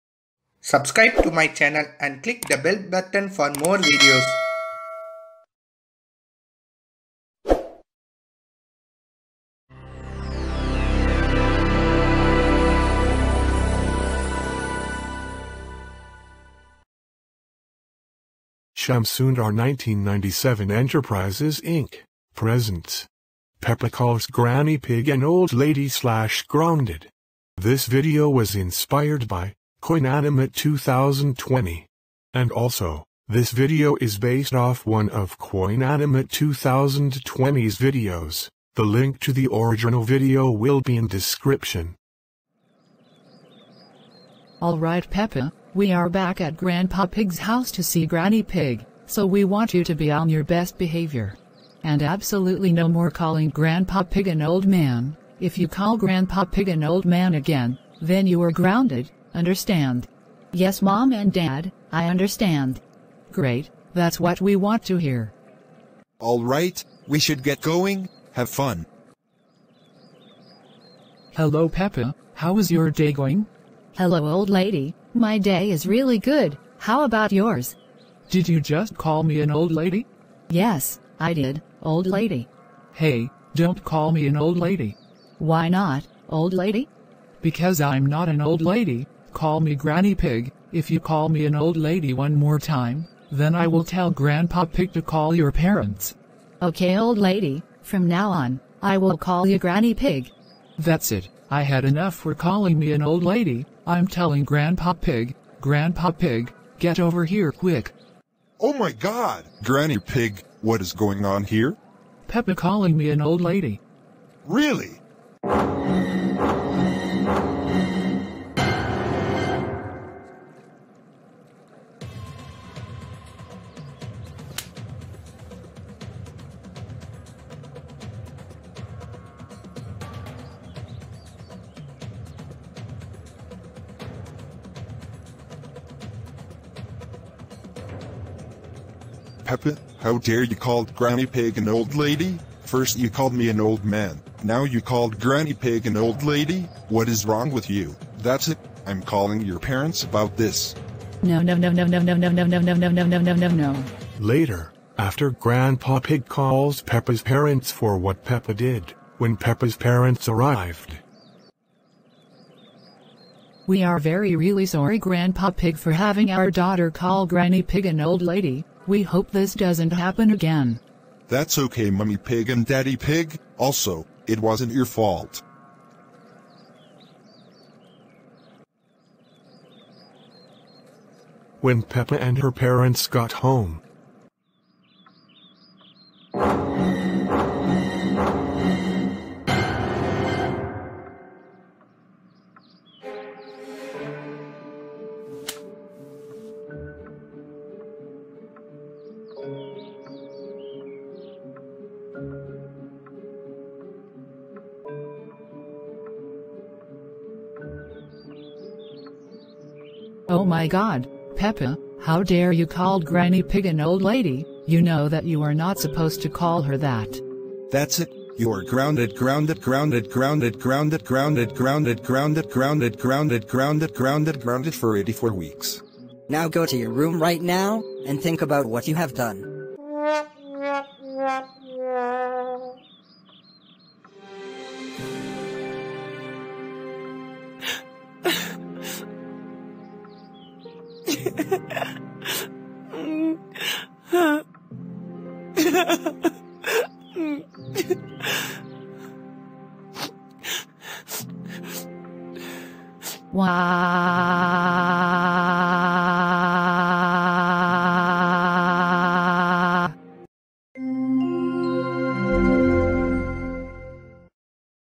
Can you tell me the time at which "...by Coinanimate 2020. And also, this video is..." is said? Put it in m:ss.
0:29.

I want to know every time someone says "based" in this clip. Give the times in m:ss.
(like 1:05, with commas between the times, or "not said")
0:34.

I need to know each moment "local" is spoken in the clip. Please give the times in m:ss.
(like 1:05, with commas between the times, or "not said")
not said.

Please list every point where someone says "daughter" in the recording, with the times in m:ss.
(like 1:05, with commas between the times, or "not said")
2:46.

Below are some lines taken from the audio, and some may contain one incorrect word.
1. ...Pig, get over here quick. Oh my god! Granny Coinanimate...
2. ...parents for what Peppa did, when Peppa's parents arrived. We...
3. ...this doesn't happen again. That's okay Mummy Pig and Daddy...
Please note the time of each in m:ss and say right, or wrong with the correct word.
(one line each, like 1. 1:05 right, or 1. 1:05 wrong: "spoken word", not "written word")
1. 1:46 wrong: "Pig", not "Coinanimate"
2. 2:37 right
3. 2:49 right.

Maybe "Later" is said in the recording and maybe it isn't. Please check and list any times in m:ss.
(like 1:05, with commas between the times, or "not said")
2:34.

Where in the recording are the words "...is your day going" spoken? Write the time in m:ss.
1:12.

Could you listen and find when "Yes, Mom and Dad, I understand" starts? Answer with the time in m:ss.
1:00.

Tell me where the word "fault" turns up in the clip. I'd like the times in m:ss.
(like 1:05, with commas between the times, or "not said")
2:54.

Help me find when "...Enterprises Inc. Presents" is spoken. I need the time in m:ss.
0:20.